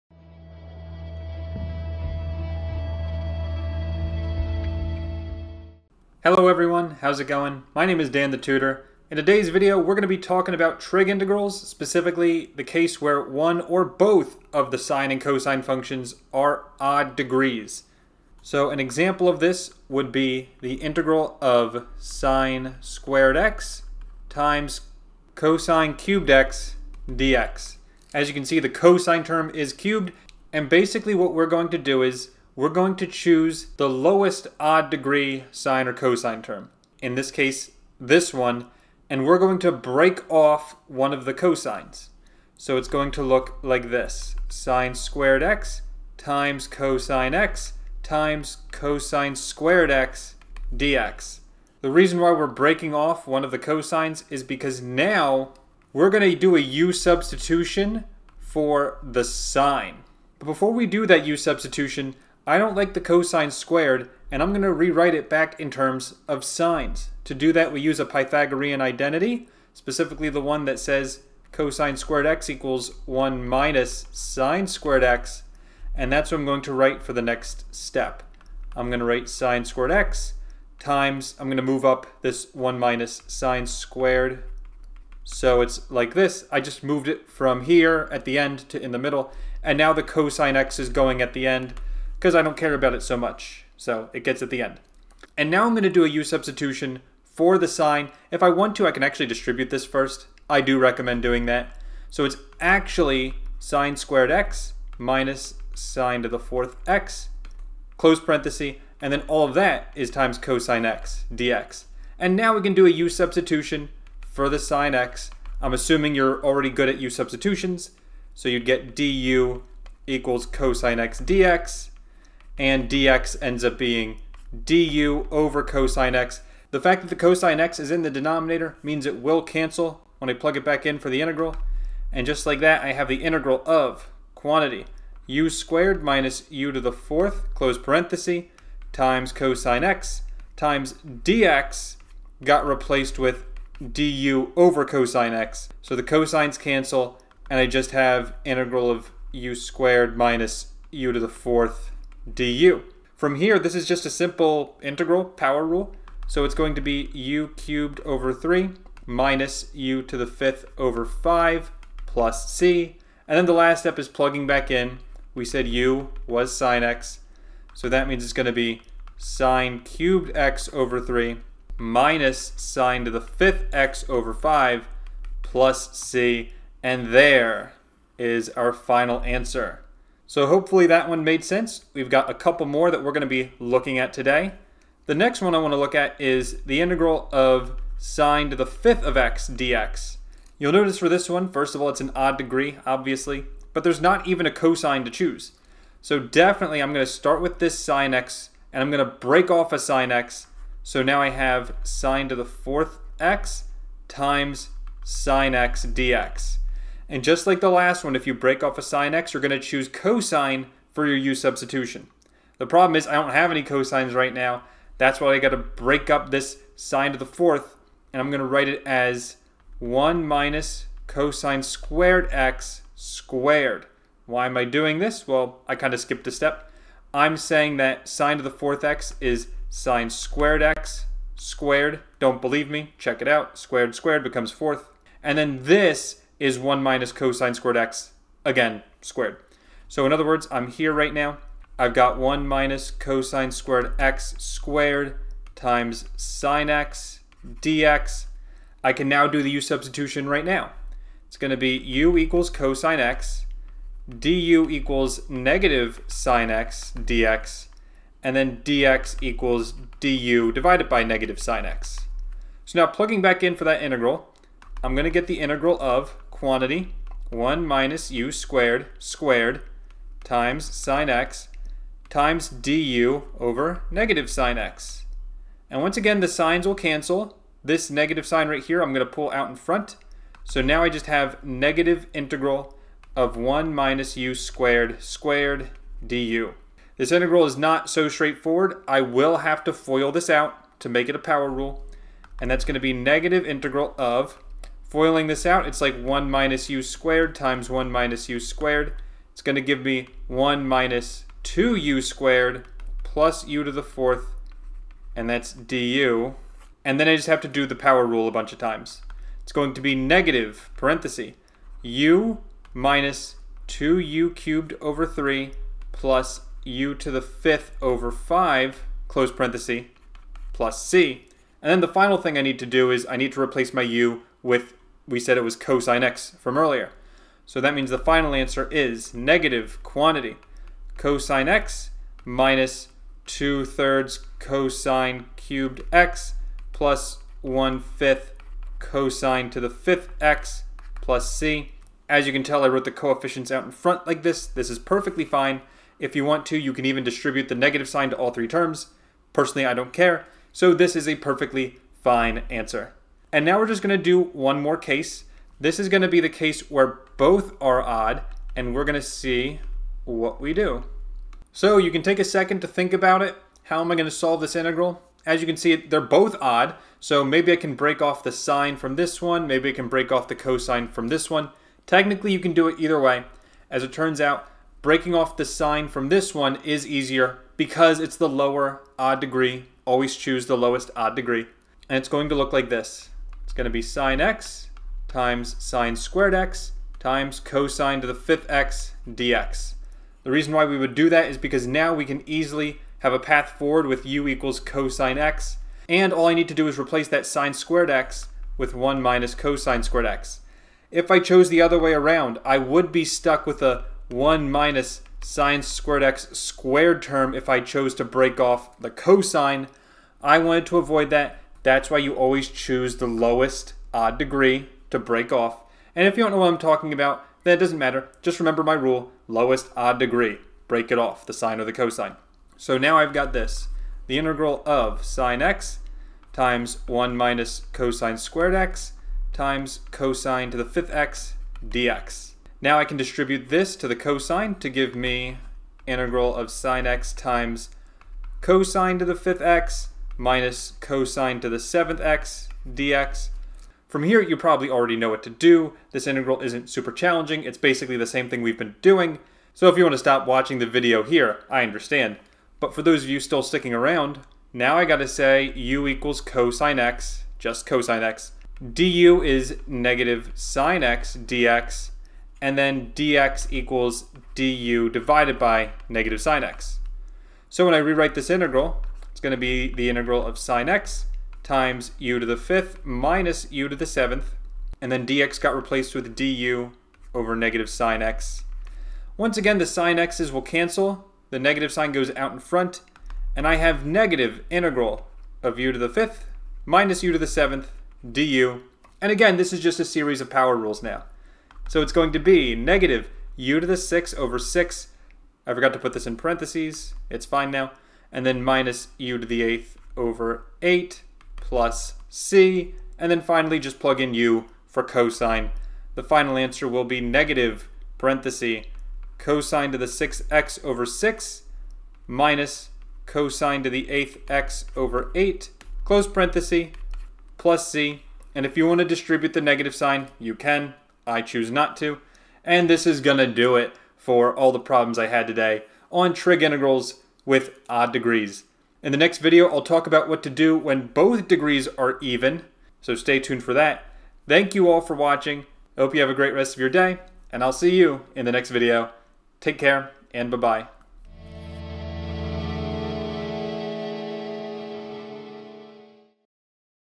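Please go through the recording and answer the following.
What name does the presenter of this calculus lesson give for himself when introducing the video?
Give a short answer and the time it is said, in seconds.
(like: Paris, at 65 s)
Dan the Tutor, at 8 s.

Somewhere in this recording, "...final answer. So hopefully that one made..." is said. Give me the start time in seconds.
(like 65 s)
178 s.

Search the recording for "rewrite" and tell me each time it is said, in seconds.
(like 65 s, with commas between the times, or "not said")
64 s, 467 s.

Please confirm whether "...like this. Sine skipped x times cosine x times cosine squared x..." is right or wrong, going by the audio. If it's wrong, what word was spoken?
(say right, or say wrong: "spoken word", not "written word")
wrong: "squared", not "skipped".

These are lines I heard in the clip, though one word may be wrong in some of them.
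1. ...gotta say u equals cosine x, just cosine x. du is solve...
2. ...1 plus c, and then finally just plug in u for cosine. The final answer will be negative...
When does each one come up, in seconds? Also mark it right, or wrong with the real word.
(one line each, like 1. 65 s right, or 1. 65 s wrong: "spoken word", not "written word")
1. 454 s wrong: "negative", not "solve"
2. 500 s wrong: "8", not "1".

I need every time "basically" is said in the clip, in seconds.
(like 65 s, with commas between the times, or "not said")
30 s, 447 s.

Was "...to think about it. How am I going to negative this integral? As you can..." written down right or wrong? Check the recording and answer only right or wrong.
wrong.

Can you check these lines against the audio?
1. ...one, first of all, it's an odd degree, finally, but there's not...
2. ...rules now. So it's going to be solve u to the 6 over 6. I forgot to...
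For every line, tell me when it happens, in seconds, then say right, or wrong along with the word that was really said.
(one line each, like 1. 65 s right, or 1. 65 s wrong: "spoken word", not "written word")
1. 191 s wrong: "obviously", not "finally"
2. 490 s wrong: "negative", not "solve".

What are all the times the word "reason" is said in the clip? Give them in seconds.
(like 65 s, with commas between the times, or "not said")
51 s, 390 s.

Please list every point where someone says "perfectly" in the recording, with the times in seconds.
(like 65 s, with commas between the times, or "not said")
344 s, 351 s.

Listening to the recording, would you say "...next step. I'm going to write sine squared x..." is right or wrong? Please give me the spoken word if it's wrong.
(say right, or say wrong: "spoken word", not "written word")
right.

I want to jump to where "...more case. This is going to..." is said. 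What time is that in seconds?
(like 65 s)
354 s.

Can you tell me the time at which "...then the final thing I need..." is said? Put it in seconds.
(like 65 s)
321 s.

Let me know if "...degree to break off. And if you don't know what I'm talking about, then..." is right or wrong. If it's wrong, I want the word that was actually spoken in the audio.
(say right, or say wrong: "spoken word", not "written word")
right.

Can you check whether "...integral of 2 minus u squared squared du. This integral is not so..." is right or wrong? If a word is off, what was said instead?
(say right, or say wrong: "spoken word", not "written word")
wrong: "1", not "2".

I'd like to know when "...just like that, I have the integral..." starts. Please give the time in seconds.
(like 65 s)
132 s.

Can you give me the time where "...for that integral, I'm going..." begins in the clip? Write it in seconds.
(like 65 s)
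263 s.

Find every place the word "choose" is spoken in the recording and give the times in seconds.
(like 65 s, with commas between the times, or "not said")
33 s, 195 s, 209 s, 380 s, 412 s, 521 s.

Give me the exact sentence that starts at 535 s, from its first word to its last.
Hope you have a great rest of your day, and I'll see you in the next video.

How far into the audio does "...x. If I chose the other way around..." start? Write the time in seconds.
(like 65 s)
400 s.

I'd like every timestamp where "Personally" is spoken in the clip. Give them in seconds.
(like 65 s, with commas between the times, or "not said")
349 s.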